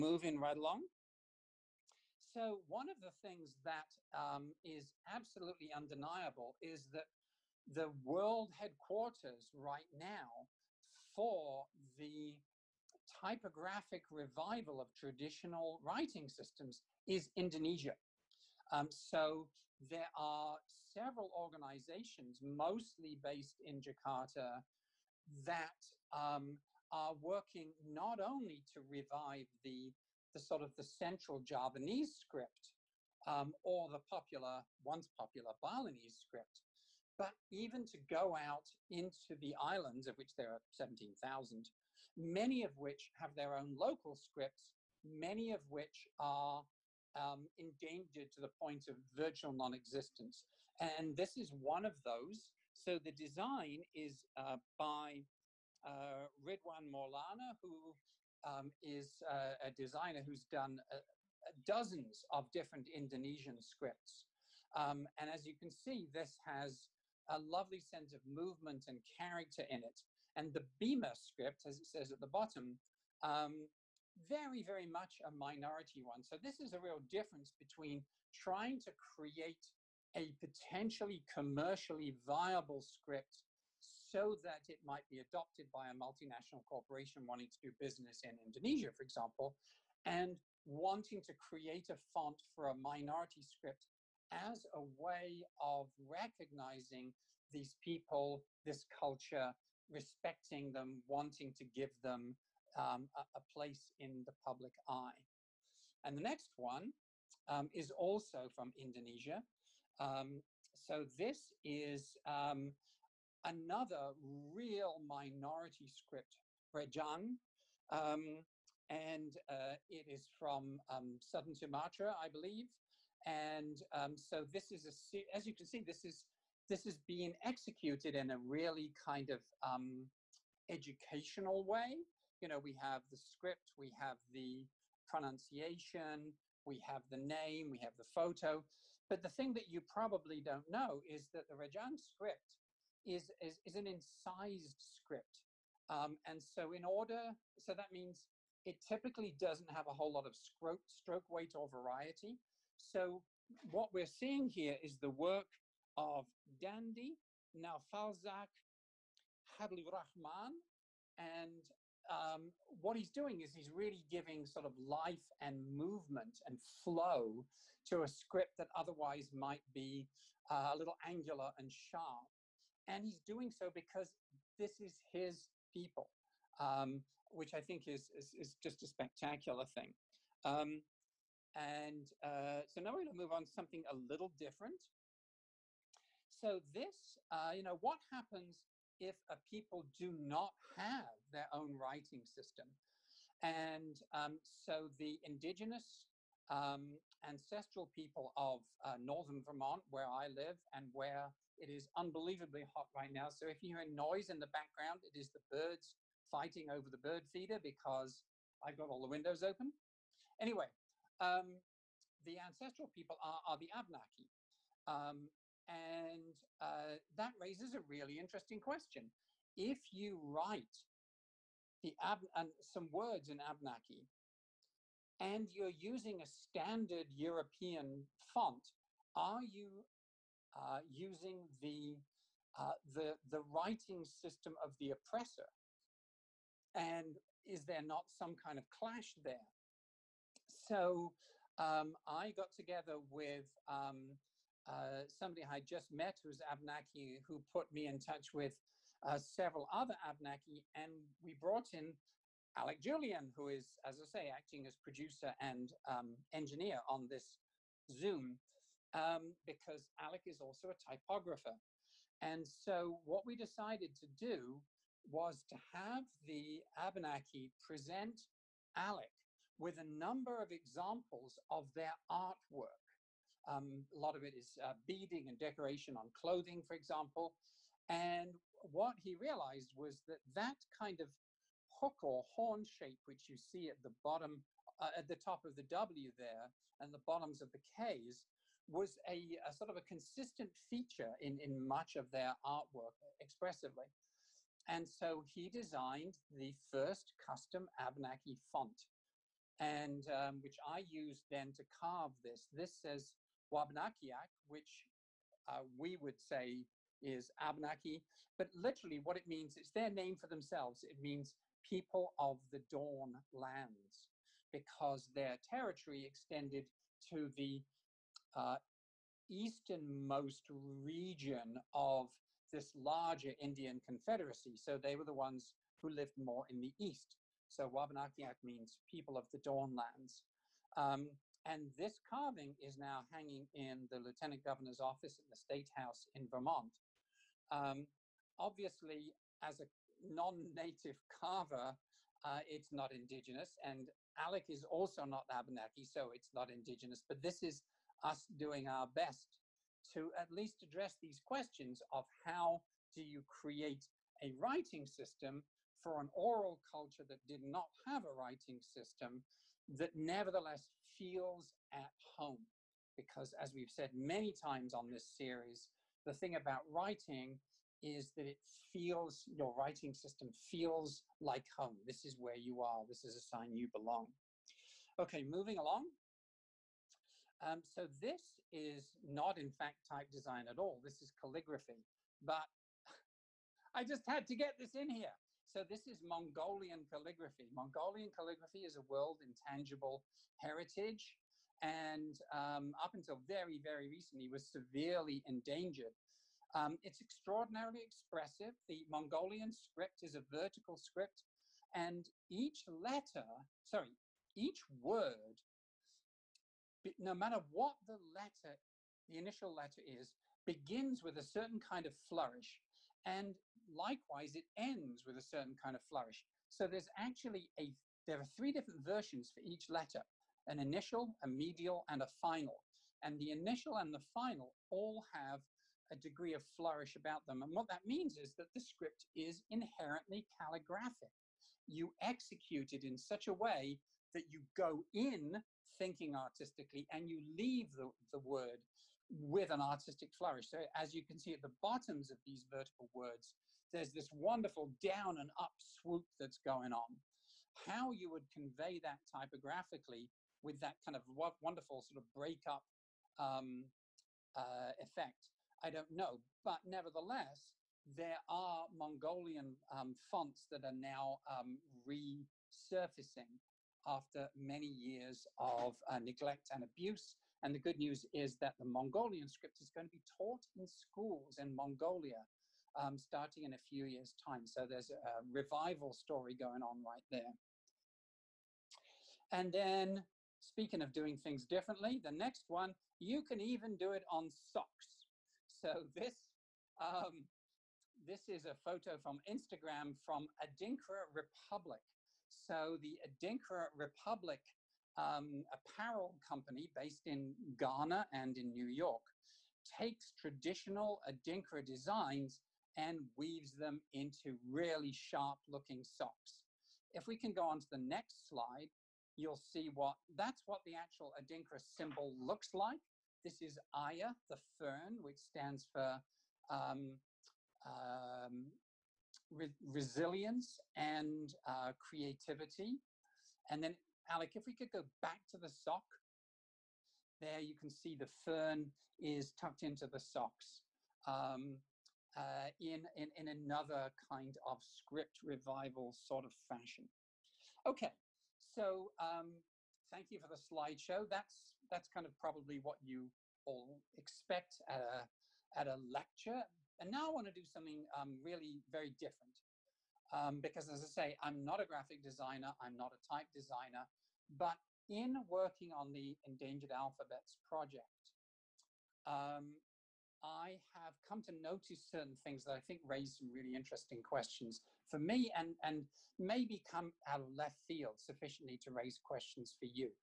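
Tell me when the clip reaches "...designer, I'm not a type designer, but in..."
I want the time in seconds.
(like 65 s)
552 s.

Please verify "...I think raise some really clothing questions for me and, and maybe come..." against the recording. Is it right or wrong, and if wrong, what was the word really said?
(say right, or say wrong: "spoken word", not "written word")
wrong: "interesting", not "clothing".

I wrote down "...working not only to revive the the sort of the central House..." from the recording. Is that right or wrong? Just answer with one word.
wrong.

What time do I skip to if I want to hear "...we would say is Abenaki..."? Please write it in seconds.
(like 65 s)
305 s.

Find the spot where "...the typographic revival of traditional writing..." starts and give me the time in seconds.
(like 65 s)
11 s.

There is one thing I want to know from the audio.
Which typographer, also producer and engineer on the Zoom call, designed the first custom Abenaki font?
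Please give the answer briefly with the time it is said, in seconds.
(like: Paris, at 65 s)
Alec Julian, at 252 s.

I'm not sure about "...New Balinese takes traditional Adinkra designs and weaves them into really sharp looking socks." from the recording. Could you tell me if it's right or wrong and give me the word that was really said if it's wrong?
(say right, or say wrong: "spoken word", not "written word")
wrong: "York", not "Balinese".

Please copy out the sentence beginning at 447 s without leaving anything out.
How you would convey that typographically with that kind of wonderful sort of breakup um, uh, effect, I don't know.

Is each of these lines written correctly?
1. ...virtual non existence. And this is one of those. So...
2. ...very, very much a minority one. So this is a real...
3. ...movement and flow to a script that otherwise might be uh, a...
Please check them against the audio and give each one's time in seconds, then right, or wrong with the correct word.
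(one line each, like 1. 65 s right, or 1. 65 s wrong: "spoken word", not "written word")
1. 49 s right
2. 74 s right
3. 165 s right.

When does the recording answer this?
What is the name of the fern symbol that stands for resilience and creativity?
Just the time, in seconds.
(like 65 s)
513 s.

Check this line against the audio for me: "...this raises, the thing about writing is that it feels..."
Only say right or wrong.
wrong.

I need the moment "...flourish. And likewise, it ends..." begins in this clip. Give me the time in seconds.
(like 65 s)
411 s.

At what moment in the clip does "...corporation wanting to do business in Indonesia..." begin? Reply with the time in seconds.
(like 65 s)
86 s.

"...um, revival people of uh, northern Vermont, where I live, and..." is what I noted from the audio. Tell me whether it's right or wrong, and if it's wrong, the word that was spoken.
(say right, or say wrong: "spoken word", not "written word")
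wrong: "ancestral", not "revival".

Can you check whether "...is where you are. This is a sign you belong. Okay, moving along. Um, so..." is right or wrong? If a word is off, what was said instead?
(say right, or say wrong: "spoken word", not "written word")
right.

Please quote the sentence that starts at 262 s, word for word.
And so what we decided to do was to have the Abenaki present Alec with a number of examples of their artwork.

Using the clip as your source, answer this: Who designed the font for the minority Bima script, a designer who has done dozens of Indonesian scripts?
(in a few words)
Ridwan Maulana.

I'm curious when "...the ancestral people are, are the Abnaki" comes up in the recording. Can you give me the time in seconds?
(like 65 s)
212 s.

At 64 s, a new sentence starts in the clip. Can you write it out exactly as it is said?
Um, and as you can see, this has a lovely sense of movement and character in it.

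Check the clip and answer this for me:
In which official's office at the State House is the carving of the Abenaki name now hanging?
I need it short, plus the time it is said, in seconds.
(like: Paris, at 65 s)
Lieutenant governor, at 333 s.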